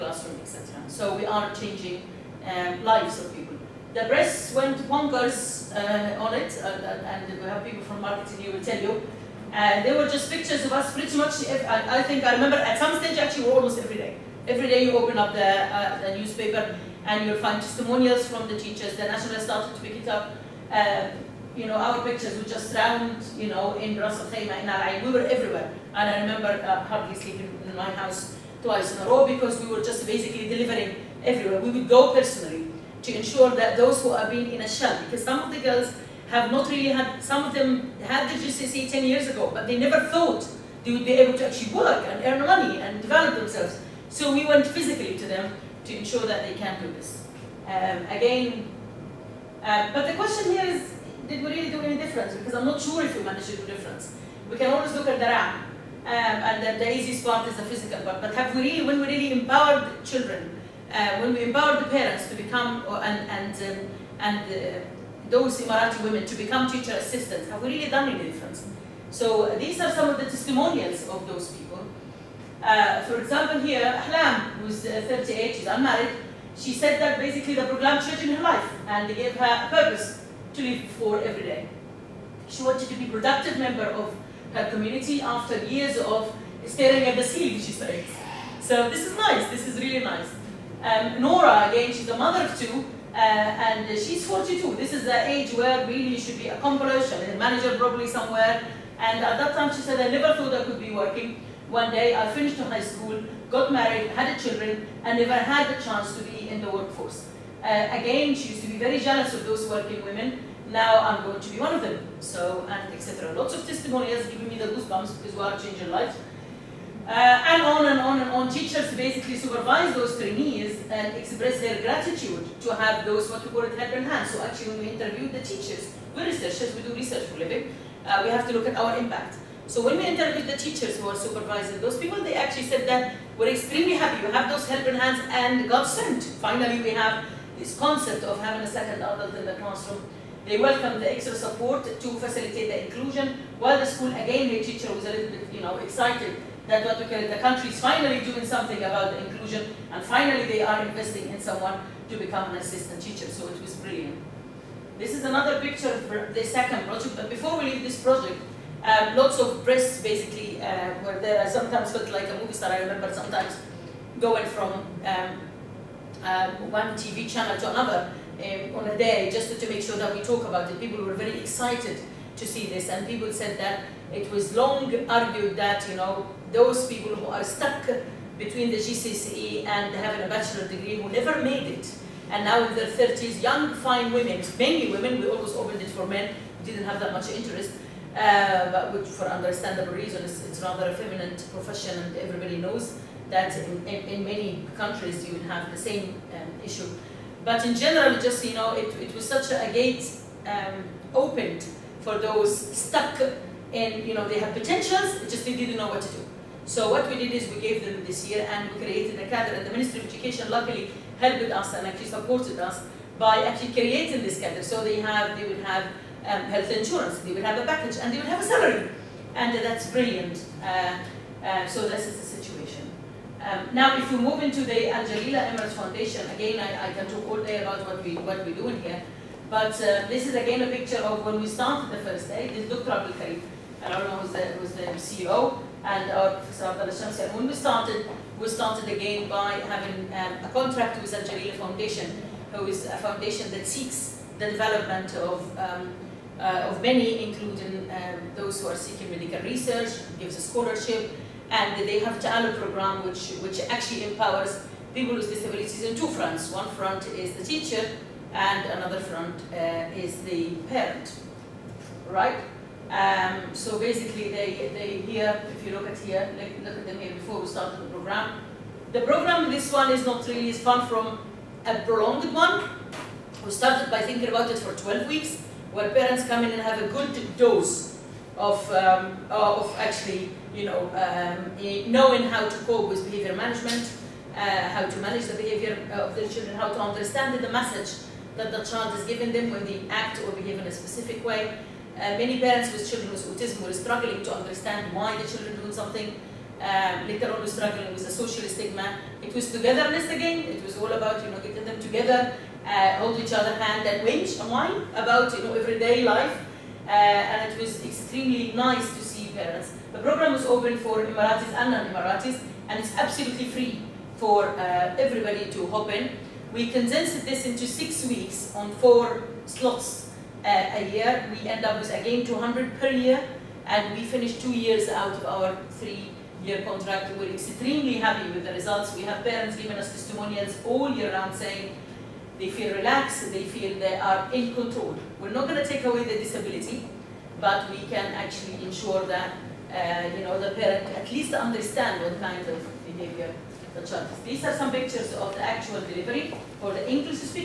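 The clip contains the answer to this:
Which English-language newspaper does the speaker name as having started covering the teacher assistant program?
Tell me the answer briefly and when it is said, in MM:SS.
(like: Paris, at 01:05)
The National, at 00:18.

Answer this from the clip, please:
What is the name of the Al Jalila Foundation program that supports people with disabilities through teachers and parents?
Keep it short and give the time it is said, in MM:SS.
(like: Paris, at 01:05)
Ta'ala, at 04:12.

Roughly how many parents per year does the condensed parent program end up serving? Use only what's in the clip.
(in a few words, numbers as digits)
200.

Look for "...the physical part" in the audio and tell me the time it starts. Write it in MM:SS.
00:57.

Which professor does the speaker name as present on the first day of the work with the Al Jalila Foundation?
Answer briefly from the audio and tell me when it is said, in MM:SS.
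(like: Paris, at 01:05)
Abdullah Shamsi, at 03:56.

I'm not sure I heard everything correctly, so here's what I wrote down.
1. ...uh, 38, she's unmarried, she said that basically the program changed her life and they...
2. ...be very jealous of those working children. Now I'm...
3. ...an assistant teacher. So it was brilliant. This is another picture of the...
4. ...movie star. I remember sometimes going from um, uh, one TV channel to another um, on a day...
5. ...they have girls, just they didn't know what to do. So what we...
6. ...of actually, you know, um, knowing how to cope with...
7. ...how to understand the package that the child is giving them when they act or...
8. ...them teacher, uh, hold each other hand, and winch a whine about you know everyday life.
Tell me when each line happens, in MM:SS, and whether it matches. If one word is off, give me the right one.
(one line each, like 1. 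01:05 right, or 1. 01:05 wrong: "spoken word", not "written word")
1. 01:14 right
2. 01:48 wrong: "women", not "children"
3. 02:32 right
4. 02:42 right
5. 03:24 wrong: "potentials", not "girls"
6. 04:39 right
7. 04:46 wrong: "message", not "package"
8. 05:01 wrong: "together", not "teacher".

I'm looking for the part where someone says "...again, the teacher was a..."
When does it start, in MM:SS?
02:24.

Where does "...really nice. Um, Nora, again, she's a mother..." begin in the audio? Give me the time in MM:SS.
01:29.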